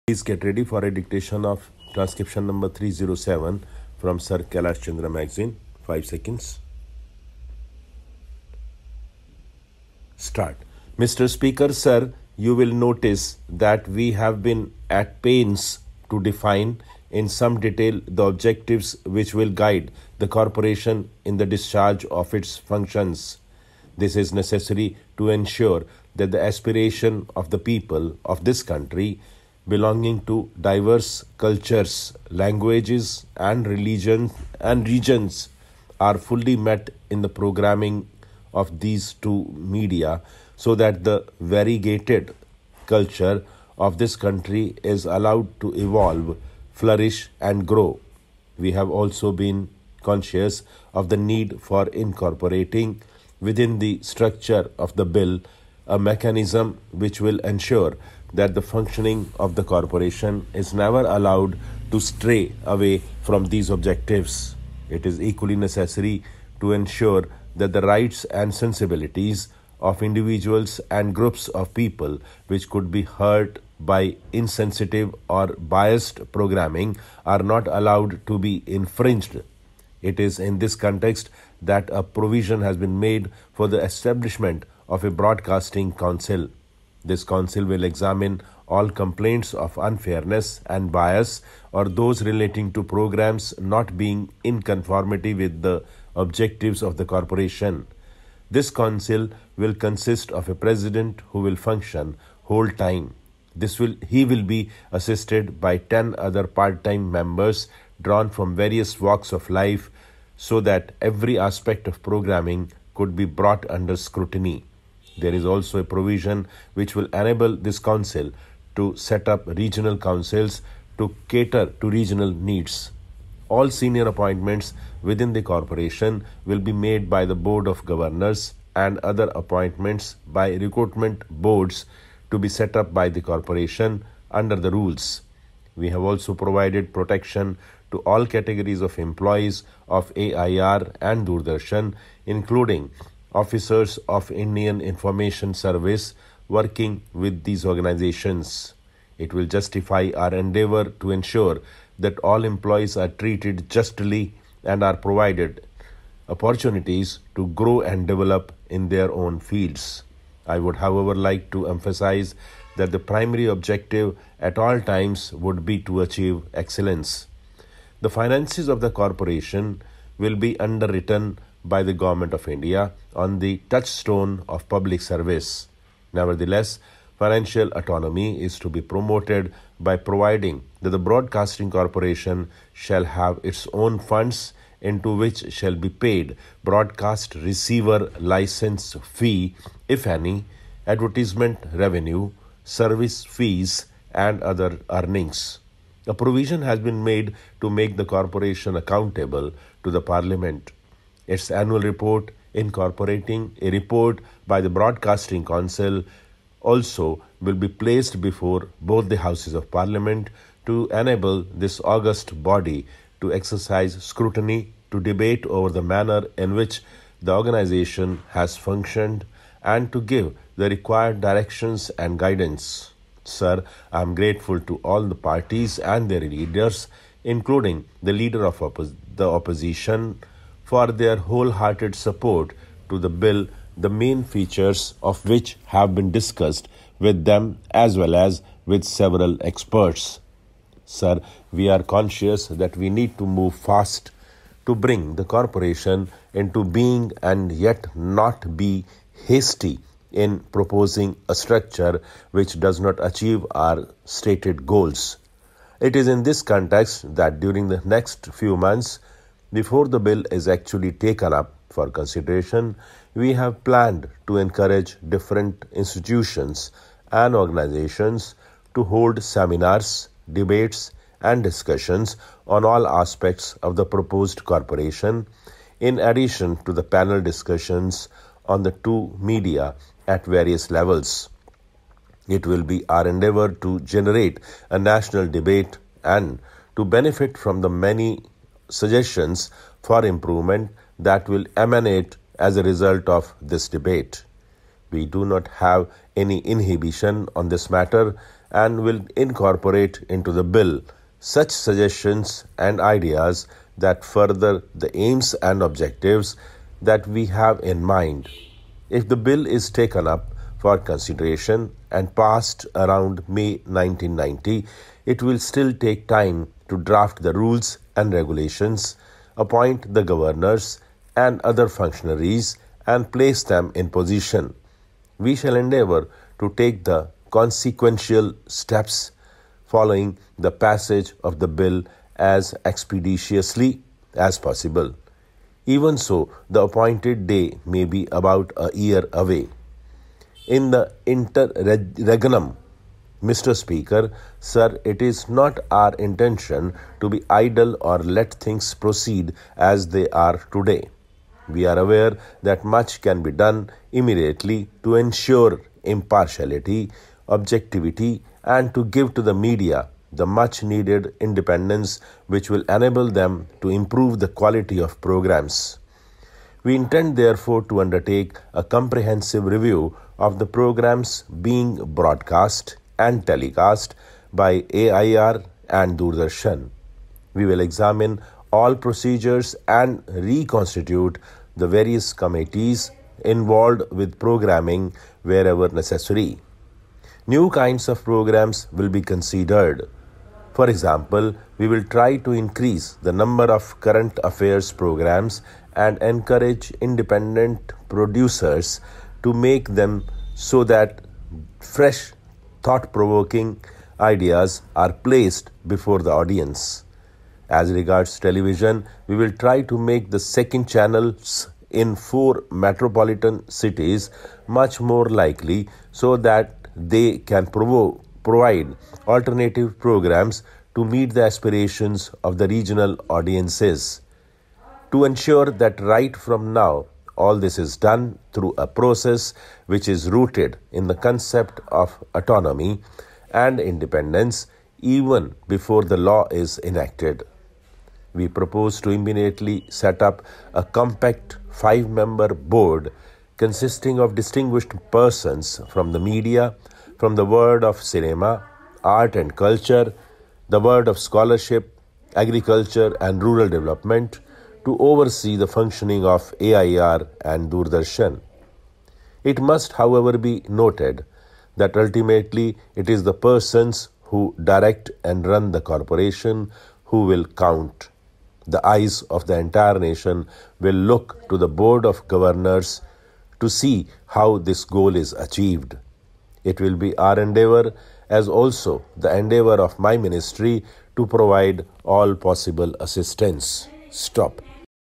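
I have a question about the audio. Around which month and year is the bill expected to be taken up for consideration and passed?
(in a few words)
May 1990.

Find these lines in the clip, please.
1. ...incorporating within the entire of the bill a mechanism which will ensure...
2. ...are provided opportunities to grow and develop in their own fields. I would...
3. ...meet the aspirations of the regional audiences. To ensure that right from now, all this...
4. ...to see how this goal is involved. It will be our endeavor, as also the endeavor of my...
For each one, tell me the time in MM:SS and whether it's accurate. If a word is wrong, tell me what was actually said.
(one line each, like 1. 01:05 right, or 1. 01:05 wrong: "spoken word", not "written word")
1. 00:51 wrong: "structure", not "entire"
2. 02:34 right
3. 07:00 right
4. 07:53 wrong: "achieved", not "involved".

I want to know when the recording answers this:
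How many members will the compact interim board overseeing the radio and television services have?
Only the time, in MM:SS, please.
07:21.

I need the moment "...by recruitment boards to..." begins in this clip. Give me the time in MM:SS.
02:10.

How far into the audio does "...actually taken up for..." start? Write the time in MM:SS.
04:20.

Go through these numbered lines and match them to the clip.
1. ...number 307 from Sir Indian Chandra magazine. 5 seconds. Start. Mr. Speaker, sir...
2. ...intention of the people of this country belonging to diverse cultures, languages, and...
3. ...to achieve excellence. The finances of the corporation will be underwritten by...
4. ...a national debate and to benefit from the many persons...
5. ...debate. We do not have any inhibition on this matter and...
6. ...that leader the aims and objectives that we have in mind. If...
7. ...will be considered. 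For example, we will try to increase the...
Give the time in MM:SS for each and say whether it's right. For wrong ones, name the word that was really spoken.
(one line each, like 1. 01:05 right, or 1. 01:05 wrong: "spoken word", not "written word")
1. 00:02 wrong: "Kailash", not "Indian"
2. 00:26 wrong: "aspiration", not "intention"
3. 02:45 right
4. 04:44 wrong: "suggestions", not "persons"
5. 04:53 right
6. 05:03 wrong: "further", not "leader"
7. 06:28 right.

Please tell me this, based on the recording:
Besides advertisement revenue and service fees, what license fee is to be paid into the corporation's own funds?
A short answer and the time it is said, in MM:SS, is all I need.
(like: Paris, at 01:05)
broadcast receiver license fee, at 03:06.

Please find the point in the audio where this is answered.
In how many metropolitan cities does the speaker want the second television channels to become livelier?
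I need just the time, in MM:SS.
06:51.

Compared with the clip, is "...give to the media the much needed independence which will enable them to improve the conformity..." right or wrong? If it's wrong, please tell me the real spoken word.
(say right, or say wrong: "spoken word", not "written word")
wrong: "quality", not "conformity".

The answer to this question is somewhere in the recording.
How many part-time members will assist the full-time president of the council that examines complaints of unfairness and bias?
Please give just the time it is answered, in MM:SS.
01:45.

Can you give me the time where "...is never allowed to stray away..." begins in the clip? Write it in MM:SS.
01:00.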